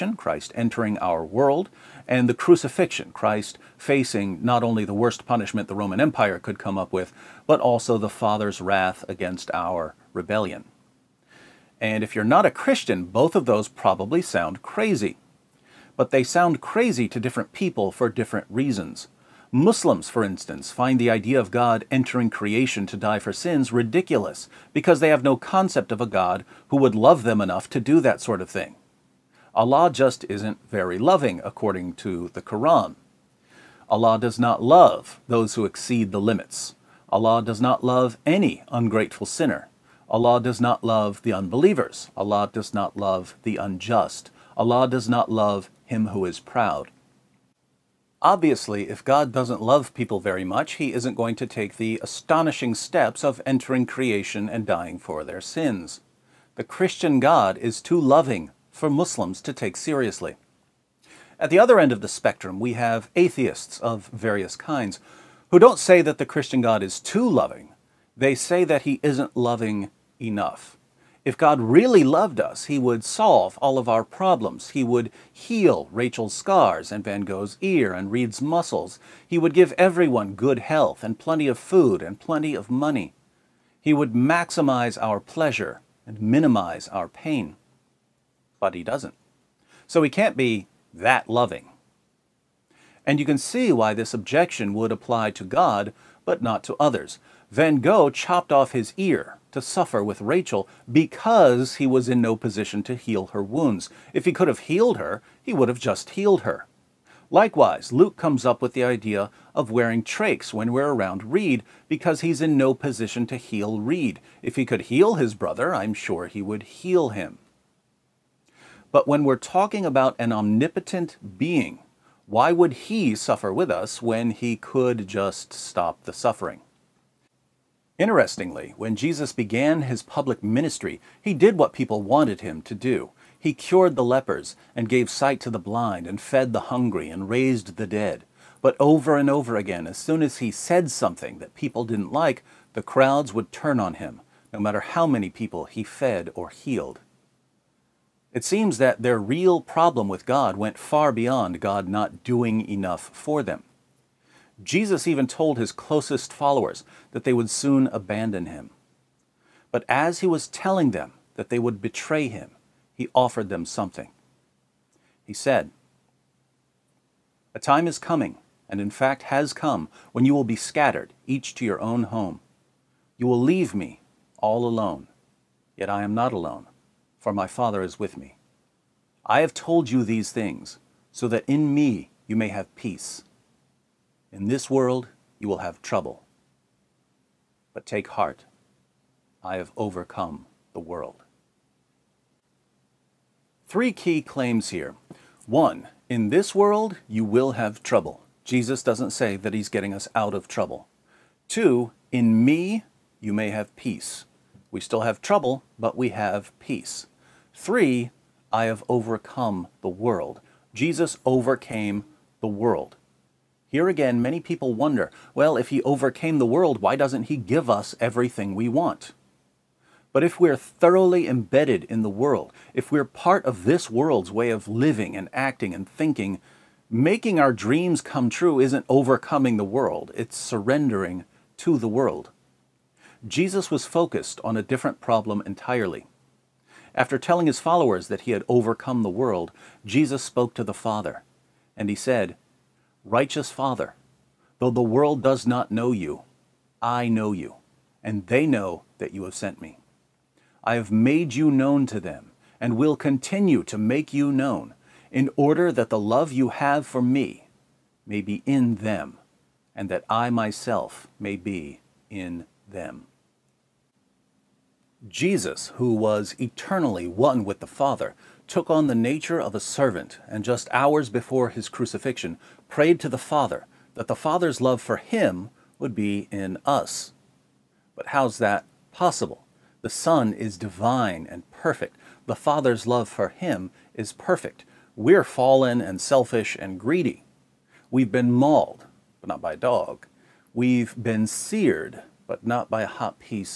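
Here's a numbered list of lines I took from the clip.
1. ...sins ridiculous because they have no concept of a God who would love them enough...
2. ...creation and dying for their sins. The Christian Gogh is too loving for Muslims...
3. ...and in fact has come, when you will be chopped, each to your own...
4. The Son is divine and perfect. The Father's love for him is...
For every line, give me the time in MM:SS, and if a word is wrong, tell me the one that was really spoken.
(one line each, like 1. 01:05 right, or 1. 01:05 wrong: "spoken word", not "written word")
1. 00:23 right
2. 00:53 wrong: "God", not "Gogh"
3. 02:48 wrong: "scattered", not "chopped"
4. 04:39 right.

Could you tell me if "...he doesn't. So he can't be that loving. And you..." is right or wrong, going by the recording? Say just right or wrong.
right.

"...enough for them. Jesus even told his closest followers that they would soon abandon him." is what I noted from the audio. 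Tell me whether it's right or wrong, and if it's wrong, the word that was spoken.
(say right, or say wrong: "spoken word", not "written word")
right.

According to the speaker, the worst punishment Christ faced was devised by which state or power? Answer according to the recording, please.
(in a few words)
Roman Empire.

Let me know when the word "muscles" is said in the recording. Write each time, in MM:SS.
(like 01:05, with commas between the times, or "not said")
01:18.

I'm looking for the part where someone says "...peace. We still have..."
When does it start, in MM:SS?
03:23.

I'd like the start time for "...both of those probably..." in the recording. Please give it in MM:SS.
00:13.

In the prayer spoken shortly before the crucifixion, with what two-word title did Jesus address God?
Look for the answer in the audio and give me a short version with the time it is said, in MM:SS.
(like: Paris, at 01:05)
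Righteous Father, at 04:03.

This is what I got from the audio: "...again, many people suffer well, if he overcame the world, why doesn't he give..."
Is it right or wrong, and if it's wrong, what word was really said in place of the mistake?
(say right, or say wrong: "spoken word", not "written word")
wrong: "wonder", not "suffer".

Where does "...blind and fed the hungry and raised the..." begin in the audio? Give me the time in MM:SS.
02:15.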